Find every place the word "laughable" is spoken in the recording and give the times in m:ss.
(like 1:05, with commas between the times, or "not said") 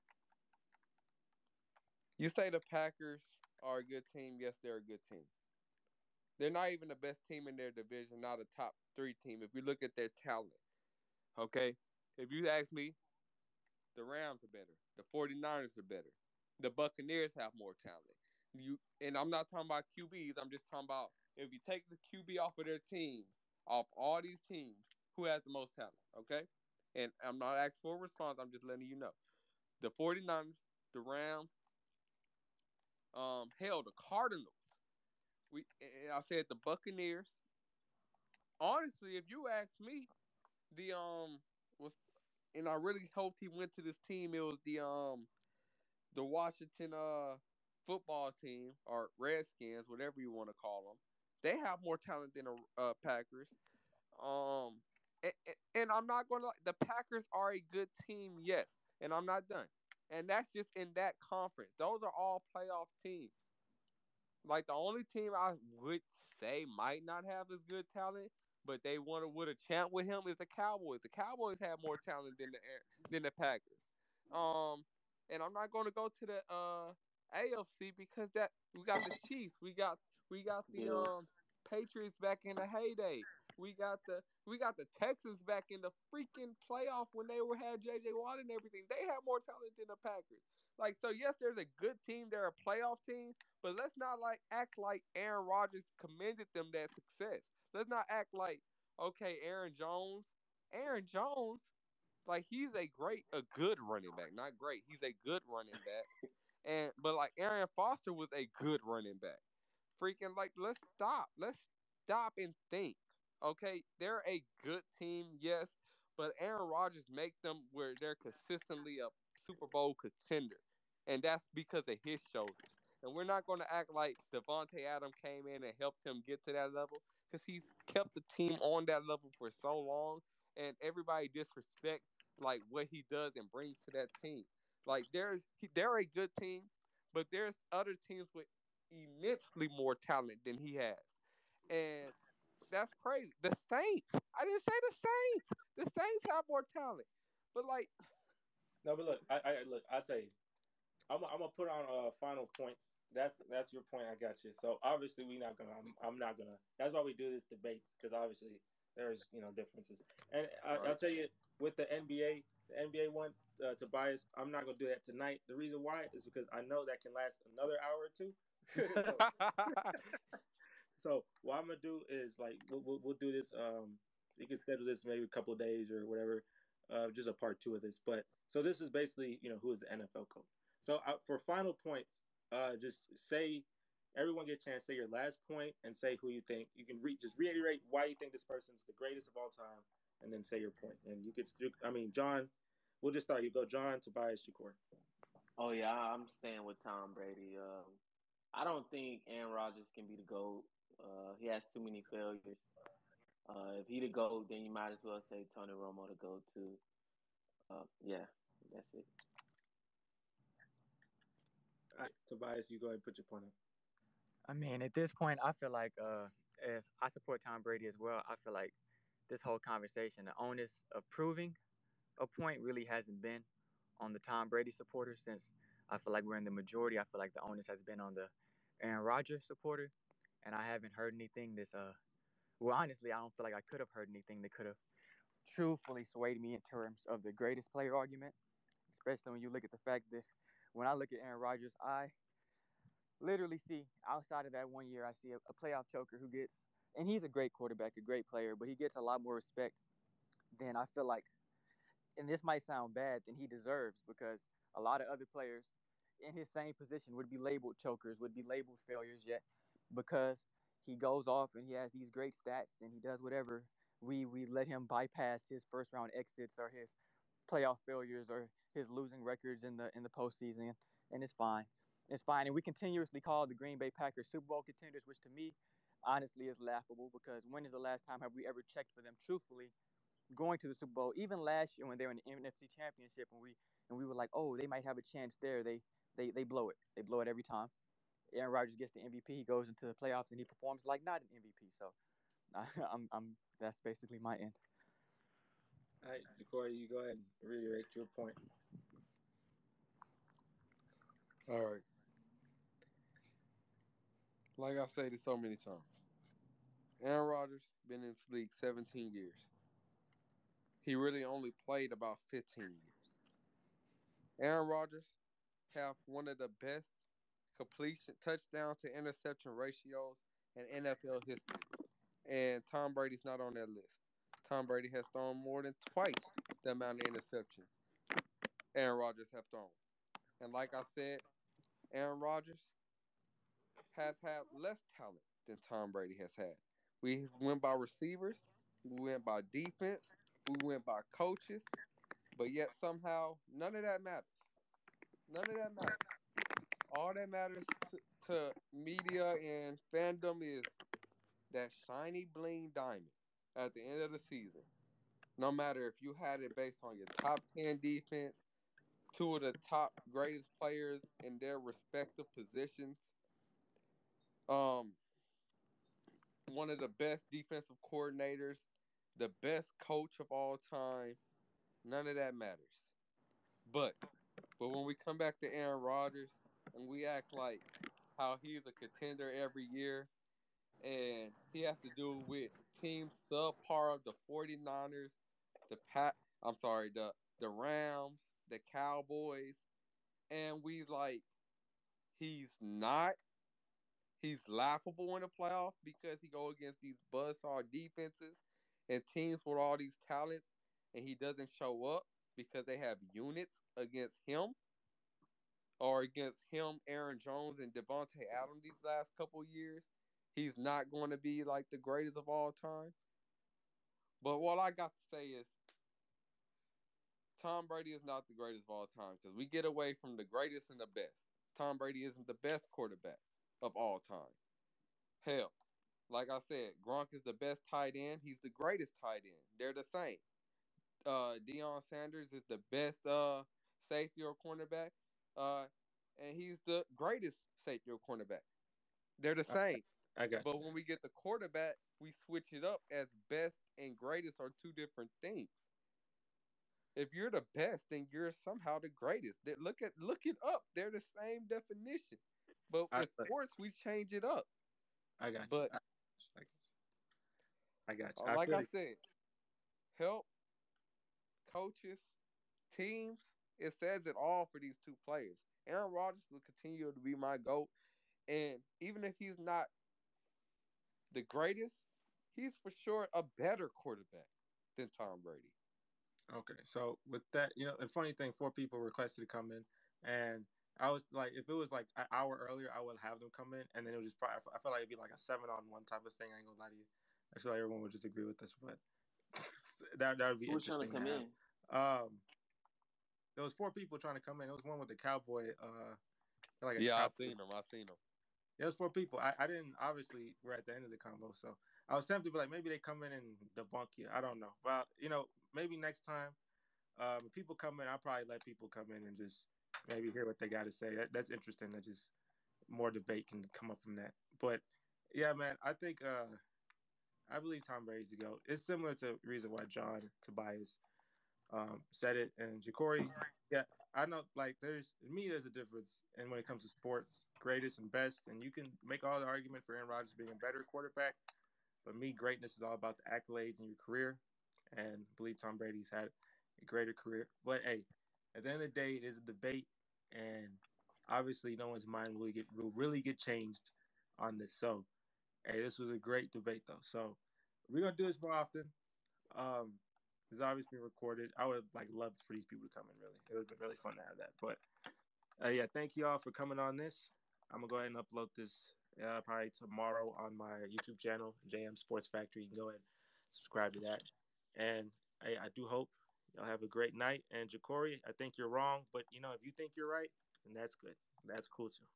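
4:36, 6:34.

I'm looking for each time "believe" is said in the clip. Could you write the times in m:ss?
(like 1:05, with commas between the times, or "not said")
8:37, 8:55.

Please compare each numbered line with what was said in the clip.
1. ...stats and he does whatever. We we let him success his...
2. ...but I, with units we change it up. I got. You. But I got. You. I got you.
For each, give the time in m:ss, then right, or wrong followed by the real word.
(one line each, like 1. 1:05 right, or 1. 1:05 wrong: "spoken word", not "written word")
1. 4:22 wrong: "bypass", not "success"
2. 7:32 wrong: "sports", not "units".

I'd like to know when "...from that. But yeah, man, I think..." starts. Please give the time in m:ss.
8:33.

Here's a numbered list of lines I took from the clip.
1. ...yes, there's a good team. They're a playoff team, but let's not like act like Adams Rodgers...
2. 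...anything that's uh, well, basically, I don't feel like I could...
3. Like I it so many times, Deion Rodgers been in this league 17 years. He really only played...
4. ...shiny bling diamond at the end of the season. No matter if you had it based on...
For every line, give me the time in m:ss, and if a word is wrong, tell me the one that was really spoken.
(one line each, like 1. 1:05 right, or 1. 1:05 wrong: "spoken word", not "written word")
1. 1:31 wrong: "Aaron", not "Adams"
2. 3:51 wrong: "honestly", not "basically"
3. 5:04 wrong: "Aaron", not "Deion"
4. 5:51 right.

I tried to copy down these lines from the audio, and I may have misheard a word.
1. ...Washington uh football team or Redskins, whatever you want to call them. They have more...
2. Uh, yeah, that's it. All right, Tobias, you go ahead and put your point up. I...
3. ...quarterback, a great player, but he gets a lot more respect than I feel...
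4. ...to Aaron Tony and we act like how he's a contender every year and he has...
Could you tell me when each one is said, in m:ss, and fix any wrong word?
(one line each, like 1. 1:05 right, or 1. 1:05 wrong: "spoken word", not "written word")
1. 0:46 right
2. 3:27 right
3. 4:07 right
4. 6:15 wrong: "Rodgers", not "Tony".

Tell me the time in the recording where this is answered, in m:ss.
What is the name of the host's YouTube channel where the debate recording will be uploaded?
9:21.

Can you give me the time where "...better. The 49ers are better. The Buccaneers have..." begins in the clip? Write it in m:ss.
0:14.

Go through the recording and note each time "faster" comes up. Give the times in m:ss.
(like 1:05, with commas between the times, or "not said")
not said.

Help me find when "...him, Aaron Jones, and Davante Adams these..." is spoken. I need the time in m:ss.
6:46.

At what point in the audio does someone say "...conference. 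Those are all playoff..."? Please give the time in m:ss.
1:01.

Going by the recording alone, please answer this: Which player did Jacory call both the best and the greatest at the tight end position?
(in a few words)
Gronk.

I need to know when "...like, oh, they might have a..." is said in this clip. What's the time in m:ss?
4:44.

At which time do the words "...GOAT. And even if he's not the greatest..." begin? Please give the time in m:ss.
7:47.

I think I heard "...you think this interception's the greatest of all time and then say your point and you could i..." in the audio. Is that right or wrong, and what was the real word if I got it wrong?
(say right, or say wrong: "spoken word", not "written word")
wrong: "person", not "interception".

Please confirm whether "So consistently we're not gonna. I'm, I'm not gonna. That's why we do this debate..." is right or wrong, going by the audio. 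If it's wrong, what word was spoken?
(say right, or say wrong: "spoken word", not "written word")
wrong: "obviously", not "consistently".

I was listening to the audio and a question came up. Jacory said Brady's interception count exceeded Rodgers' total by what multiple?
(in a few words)
twice.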